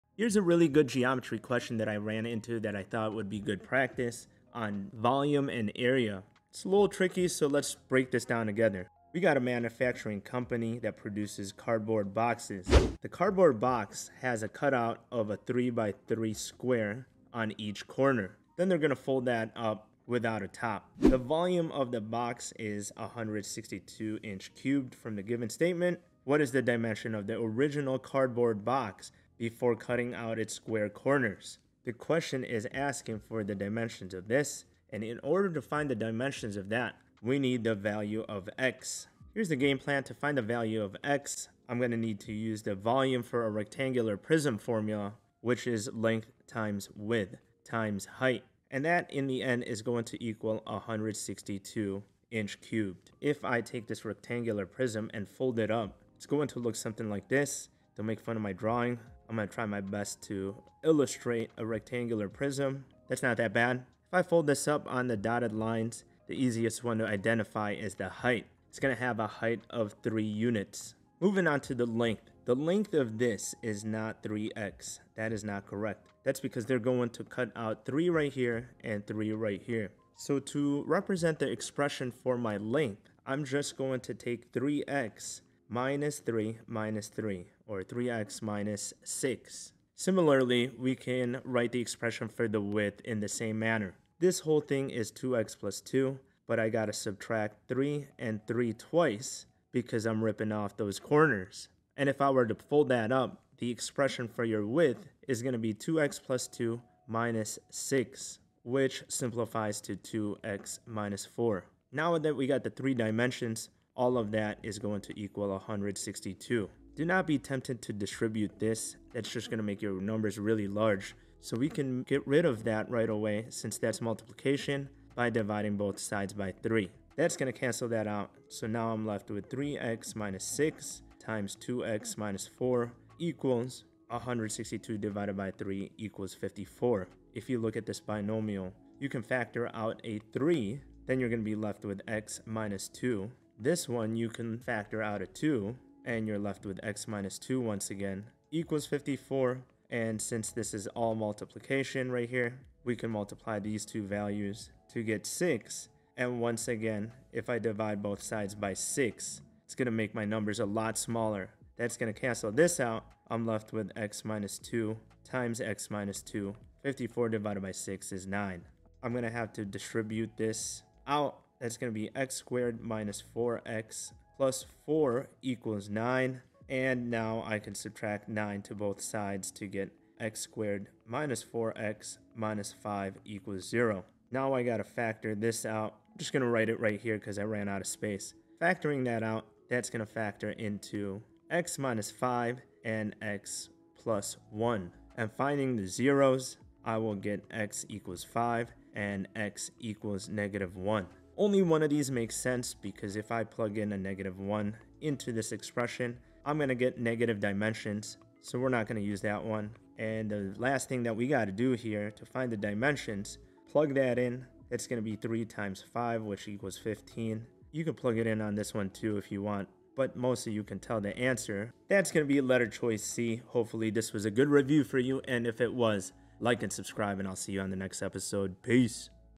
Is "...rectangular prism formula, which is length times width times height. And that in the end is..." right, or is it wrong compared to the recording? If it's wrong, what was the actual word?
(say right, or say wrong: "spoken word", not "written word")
right.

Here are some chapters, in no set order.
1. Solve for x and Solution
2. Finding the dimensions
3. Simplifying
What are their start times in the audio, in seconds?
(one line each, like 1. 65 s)
1. 168 s
2. 43 s
3. 117 s.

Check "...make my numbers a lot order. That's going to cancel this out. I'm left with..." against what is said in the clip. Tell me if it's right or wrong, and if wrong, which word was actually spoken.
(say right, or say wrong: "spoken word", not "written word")
wrong: "smaller", not "order".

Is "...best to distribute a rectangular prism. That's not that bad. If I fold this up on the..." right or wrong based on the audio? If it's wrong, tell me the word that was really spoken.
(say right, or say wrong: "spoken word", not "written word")
wrong: "illustrate", not "distribute".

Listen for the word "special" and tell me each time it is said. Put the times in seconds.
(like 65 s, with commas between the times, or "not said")
not said.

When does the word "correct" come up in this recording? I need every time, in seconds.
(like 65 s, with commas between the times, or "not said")
75 s.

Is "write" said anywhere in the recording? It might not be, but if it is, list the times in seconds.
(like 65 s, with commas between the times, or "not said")
91 s, 186 s.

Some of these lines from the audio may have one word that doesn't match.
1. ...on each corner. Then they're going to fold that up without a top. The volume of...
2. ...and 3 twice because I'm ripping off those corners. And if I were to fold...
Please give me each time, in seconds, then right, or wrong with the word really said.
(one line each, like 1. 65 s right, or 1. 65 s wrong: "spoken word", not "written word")
1. 17 s right
2. 98 s right.